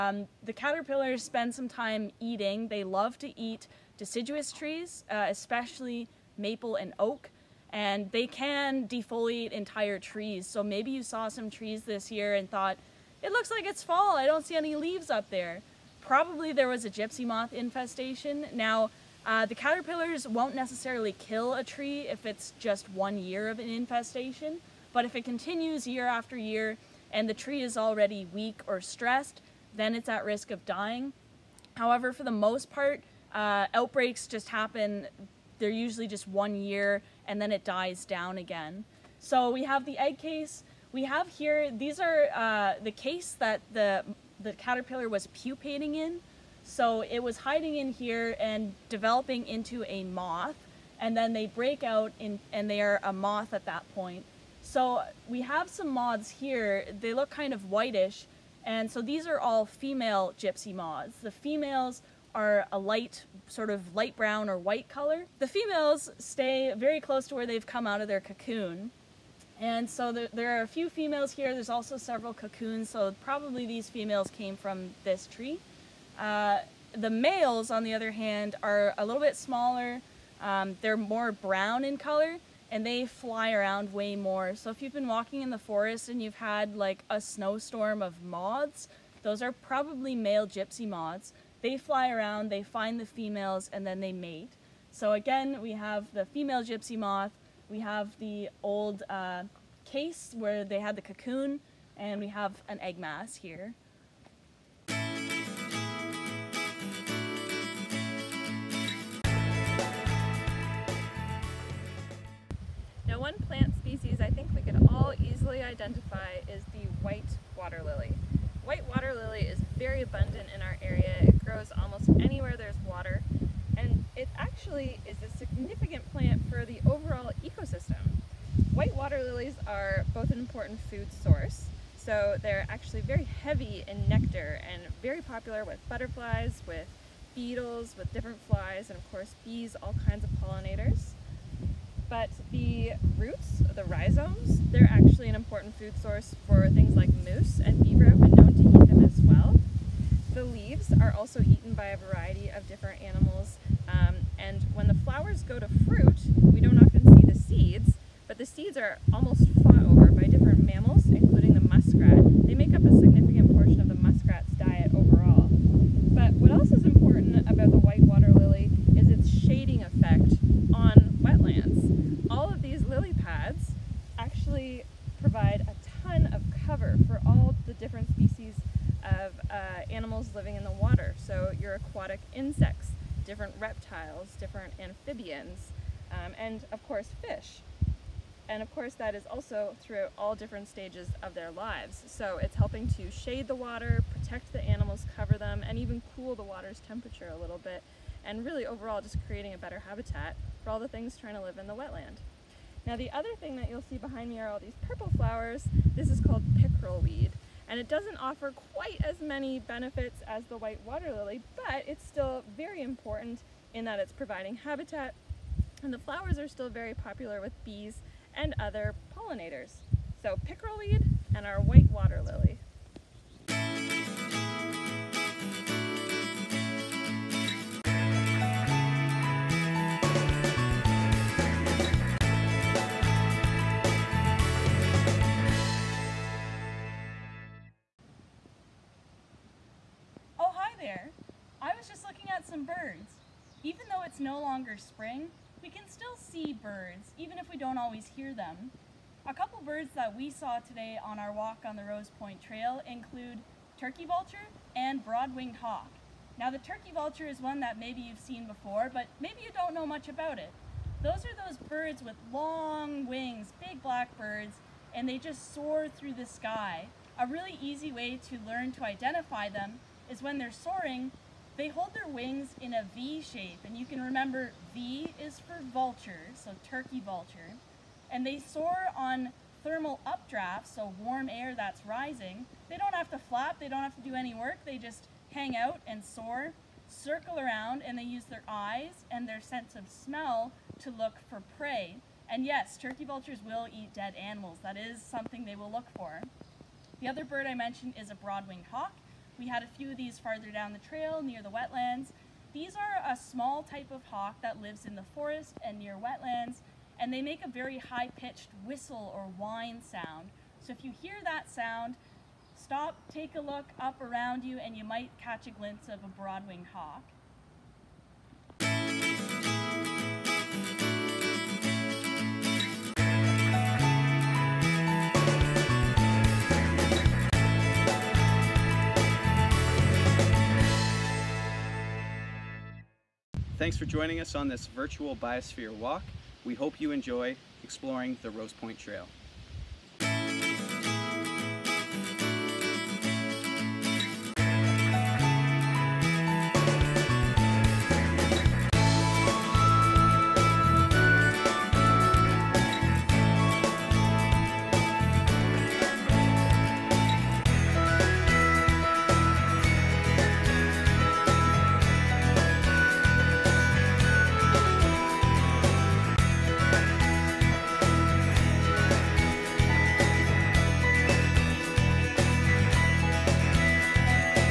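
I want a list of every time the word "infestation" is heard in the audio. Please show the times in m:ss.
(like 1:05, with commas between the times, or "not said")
0:17, 0:23.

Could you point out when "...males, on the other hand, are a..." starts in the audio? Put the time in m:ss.
1:17.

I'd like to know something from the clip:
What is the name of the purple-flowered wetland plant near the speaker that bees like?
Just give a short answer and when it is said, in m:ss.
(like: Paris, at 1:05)
pickerel weed, at 3:26.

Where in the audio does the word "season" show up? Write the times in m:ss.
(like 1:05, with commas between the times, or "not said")
not said.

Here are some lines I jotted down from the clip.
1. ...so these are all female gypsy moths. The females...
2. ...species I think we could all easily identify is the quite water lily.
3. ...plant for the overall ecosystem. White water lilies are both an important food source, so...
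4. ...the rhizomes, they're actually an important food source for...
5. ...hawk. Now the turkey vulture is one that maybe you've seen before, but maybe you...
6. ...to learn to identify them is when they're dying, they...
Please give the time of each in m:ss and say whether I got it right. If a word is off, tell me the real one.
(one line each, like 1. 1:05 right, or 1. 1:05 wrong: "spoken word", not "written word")
1. 0:58 right
2. 1:53 wrong: "white", not "quite"
3. 2:06 right
4. 2:23 right
5. 4:15 right
6. 4:28 wrong: "soaring", not "dying".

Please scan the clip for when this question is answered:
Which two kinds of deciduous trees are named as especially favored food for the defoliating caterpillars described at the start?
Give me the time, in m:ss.
0:06.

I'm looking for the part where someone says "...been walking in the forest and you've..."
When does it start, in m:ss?
1:24.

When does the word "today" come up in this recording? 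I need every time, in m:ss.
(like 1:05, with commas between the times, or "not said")
4:10.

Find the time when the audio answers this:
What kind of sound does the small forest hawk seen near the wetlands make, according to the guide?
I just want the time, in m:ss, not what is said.
5:07.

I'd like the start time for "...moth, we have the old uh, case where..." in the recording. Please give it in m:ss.
1:36.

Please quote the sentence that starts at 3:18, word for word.
And really overall just creating a better habitat for all the things trying to live in the wetland.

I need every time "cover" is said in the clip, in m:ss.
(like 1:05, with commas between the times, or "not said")
2:56, 3:15.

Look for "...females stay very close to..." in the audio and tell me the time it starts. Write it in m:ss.
1:05.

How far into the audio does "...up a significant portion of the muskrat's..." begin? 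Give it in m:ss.
2:42.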